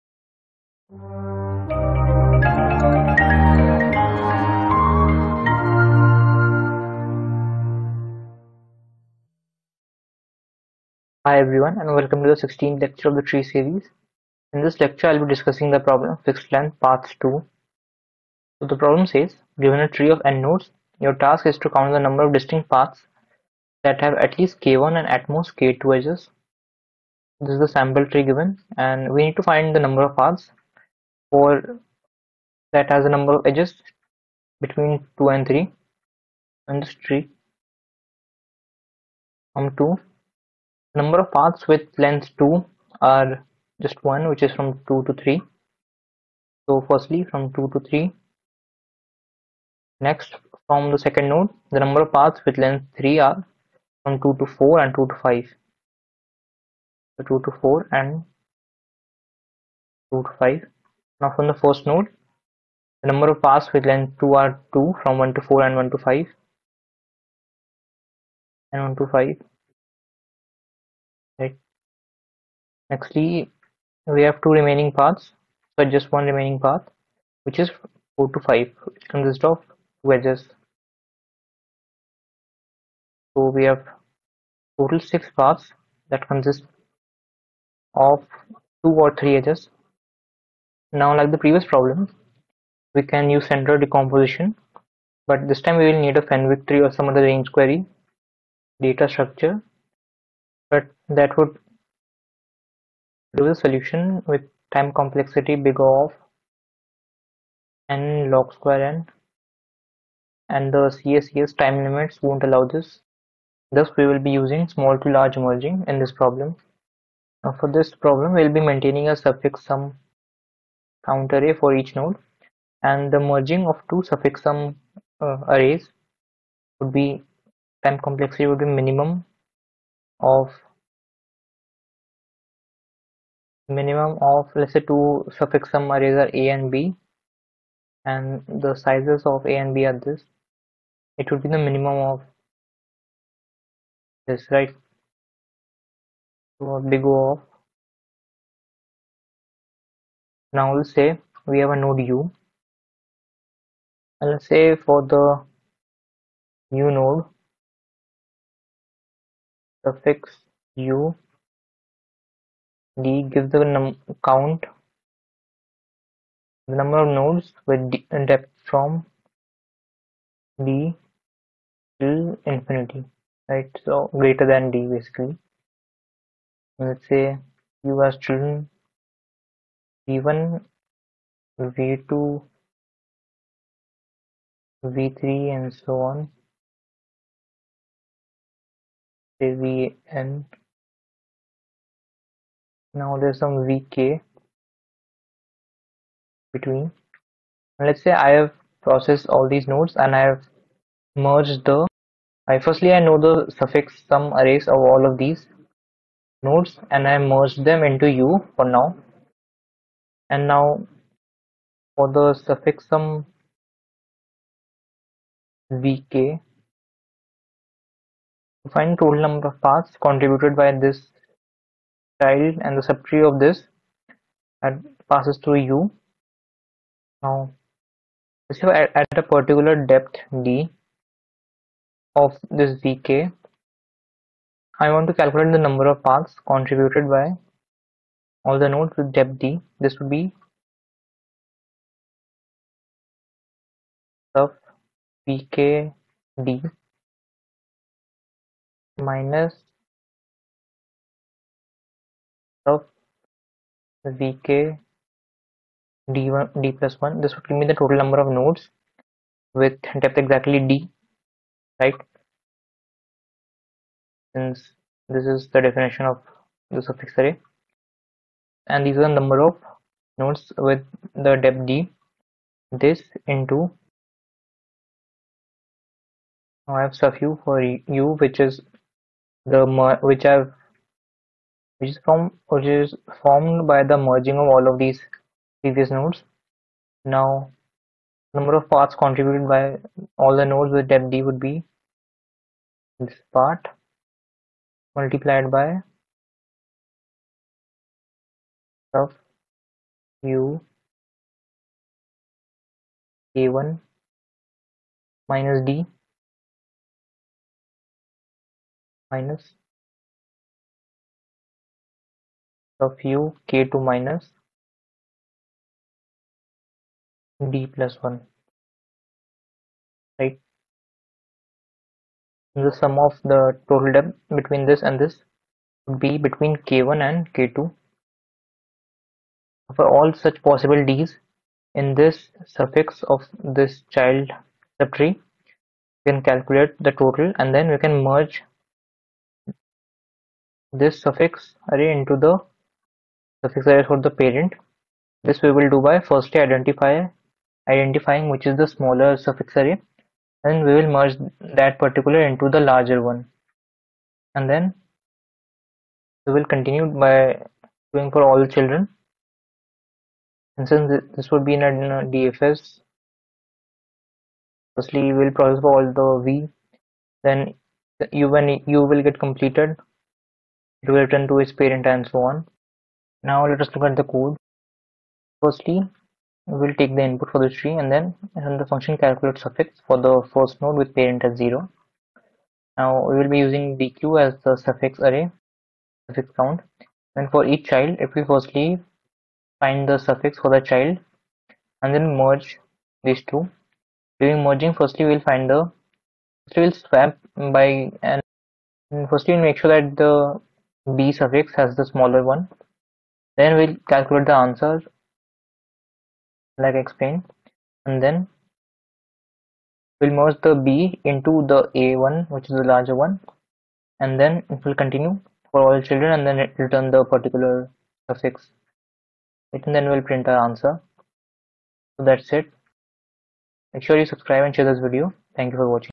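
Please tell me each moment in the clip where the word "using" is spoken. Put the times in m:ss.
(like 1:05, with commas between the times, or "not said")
1:54, 6:23.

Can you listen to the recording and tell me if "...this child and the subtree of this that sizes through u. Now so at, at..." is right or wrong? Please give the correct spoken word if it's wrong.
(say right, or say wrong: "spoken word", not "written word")
wrong: "passes", not "sizes".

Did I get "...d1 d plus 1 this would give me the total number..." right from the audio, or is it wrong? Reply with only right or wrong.
right.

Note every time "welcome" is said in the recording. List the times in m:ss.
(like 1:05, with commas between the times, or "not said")
0:11.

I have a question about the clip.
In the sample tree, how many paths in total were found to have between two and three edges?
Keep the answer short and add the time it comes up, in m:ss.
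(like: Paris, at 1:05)
6, at 1:25.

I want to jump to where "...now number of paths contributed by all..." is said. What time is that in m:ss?
4:47.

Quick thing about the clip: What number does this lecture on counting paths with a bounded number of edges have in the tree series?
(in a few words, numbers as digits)
16th.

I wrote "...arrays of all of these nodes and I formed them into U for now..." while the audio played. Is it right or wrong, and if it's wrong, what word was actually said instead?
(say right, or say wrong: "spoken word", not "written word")
wrong: "merged", not "formed".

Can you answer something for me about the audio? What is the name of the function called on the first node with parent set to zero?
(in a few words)
calculate suffix.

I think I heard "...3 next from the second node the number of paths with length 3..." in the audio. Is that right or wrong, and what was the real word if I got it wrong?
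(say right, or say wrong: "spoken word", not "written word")
right.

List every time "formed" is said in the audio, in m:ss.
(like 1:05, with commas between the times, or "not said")
4:43.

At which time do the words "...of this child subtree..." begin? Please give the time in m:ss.
5:33.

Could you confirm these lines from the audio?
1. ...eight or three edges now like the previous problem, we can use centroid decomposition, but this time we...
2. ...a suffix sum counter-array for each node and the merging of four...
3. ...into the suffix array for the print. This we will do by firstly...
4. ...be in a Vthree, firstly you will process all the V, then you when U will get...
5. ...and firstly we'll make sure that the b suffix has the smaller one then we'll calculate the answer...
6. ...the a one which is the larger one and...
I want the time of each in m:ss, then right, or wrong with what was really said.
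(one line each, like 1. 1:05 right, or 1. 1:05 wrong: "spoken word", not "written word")
1. 1:28 wrong: "two", not "eight"
2. 1:59 wrong: "two", not "four"
3. 5:41 wrong: "parent", not "print"
4. 6:01 wrong: "DFS", not "Vthree"
5. 6:38 right
6. 6:51 right.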